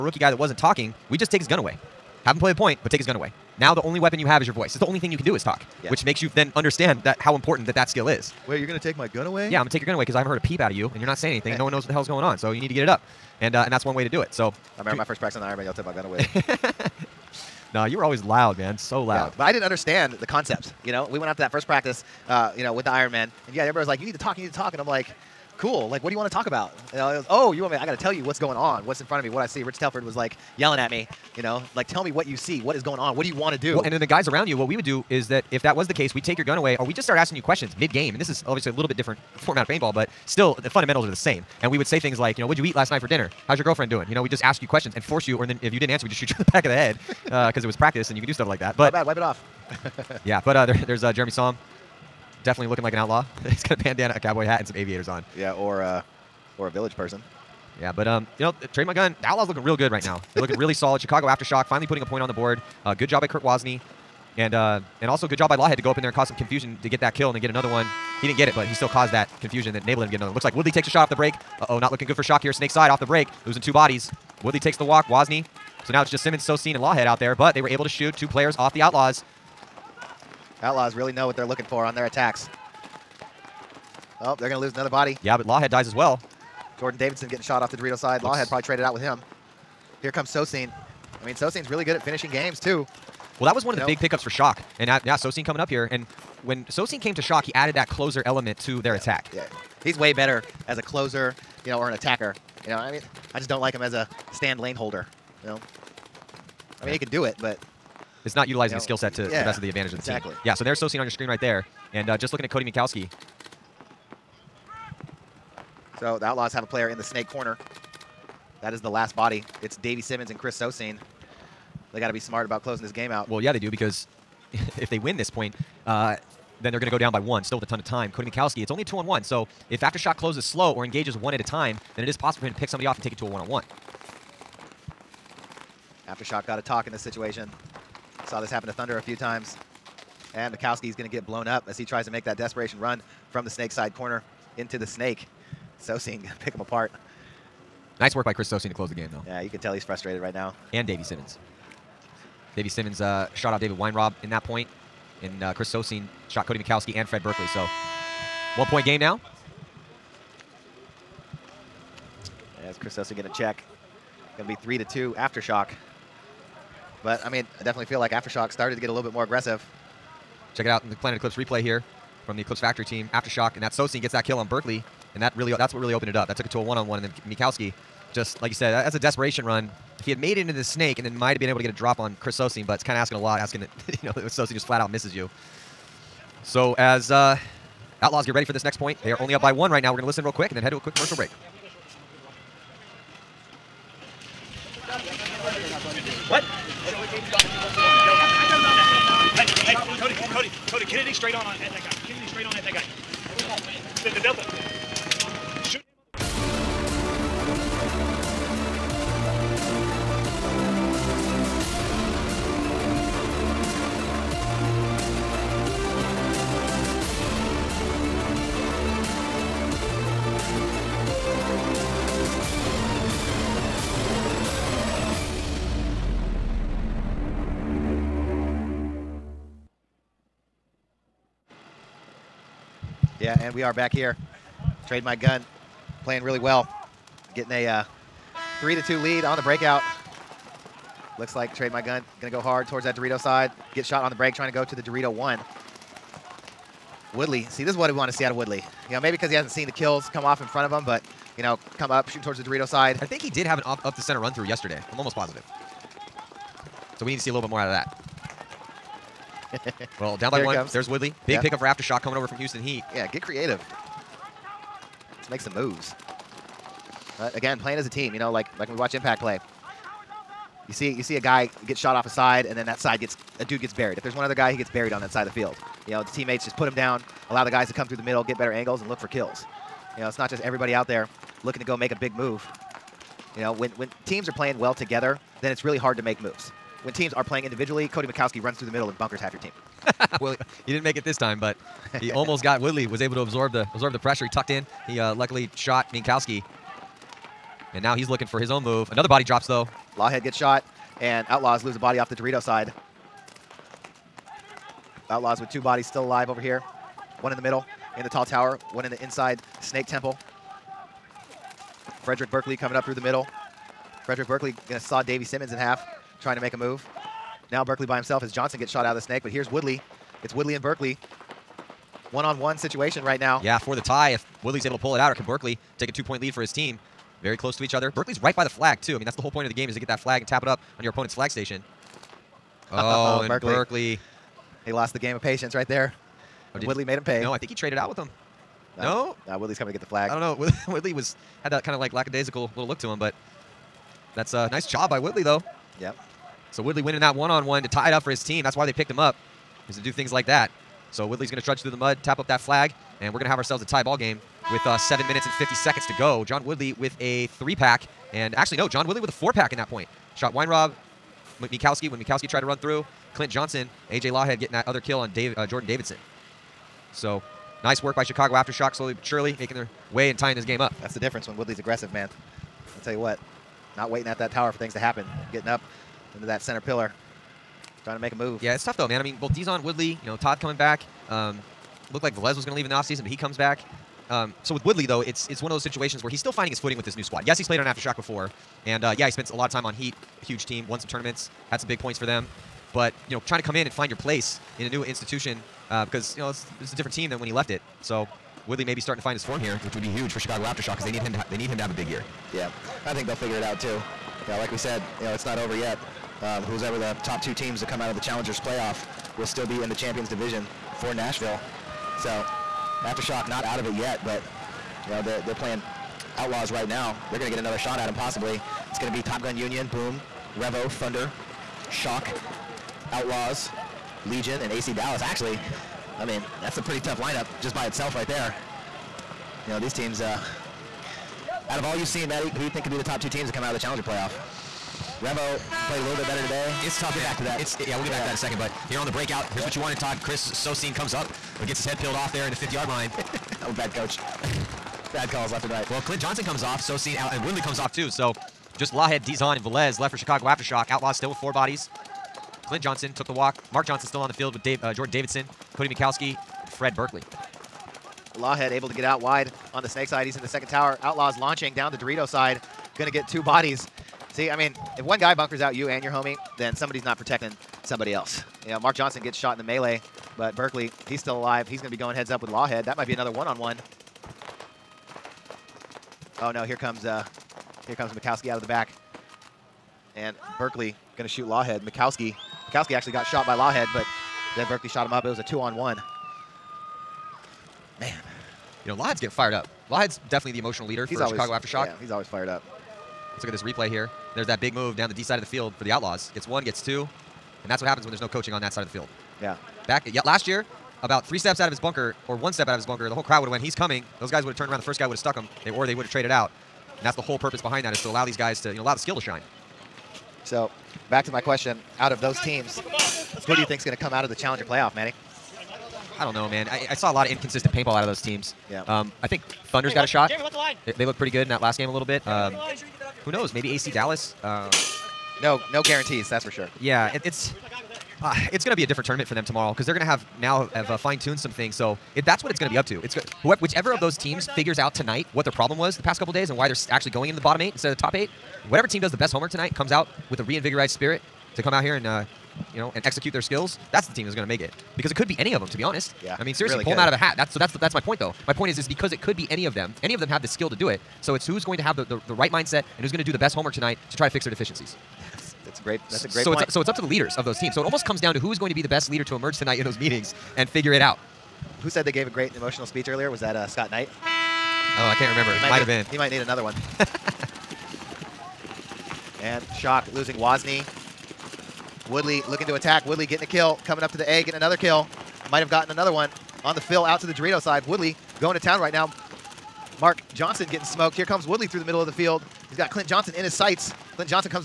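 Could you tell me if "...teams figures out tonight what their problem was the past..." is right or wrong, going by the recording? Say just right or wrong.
right.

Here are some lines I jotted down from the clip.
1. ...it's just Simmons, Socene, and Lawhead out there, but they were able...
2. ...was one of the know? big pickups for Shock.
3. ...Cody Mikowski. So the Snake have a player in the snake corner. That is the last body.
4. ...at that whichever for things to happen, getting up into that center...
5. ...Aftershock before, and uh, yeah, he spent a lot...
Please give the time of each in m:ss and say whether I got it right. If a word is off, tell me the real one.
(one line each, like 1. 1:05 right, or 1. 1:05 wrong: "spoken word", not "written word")
1. 1:16 right
2. 1:33 right
3. 1:52 wrong: "Outlaws", not "Snake"
4. 6:14 wrong: "tower", not "whichever"
5. 6:27 right.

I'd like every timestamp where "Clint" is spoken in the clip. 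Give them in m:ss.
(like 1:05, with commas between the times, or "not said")
6:03, 7:25, 7:32, 9:42.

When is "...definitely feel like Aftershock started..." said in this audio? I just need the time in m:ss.
2:47.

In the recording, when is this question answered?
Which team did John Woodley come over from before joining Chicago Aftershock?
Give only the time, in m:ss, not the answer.
4:22.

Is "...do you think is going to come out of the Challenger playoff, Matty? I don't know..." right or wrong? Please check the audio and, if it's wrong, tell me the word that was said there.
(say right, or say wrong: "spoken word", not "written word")
right.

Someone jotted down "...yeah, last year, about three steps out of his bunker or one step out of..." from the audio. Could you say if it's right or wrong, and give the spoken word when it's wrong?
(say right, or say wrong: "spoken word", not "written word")
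right.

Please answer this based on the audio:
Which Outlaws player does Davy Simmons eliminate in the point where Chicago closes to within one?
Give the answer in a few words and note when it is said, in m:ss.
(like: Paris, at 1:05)
David Weinrob, at 2:33.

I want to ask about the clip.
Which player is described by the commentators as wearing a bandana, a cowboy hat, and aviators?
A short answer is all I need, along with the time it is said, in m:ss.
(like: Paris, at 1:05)
Jeremy Som, at 0:51.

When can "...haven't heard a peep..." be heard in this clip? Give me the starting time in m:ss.
0:10.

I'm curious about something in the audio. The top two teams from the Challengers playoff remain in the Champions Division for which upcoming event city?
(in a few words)
Nashville.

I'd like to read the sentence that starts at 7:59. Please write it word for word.
And Berkeley going to shoot Lawhead.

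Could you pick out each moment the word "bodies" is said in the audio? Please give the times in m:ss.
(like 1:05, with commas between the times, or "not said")
1:13, 5:05, 7:31, 7:43.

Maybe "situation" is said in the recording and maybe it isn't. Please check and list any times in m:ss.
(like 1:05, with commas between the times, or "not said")
2:16, 5:22, 6:25.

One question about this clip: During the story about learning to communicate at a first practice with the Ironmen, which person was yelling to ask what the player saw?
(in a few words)
Rich Telford.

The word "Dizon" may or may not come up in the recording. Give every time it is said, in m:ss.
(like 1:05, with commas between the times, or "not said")
6:19, 7:29.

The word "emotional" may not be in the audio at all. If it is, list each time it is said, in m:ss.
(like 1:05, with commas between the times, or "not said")
8:10, 9:22.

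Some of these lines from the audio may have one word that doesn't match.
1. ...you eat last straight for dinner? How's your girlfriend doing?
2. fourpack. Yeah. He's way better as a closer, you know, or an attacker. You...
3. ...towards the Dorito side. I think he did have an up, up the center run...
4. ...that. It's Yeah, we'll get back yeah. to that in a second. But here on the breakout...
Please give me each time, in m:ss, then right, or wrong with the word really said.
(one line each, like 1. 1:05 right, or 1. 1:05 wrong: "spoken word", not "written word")
1. 0:42 wrong: "night", not "straight"
2. 1:38 wrong: "attack", not "fourpack"
3. 4:12 right
4. 7:17 right.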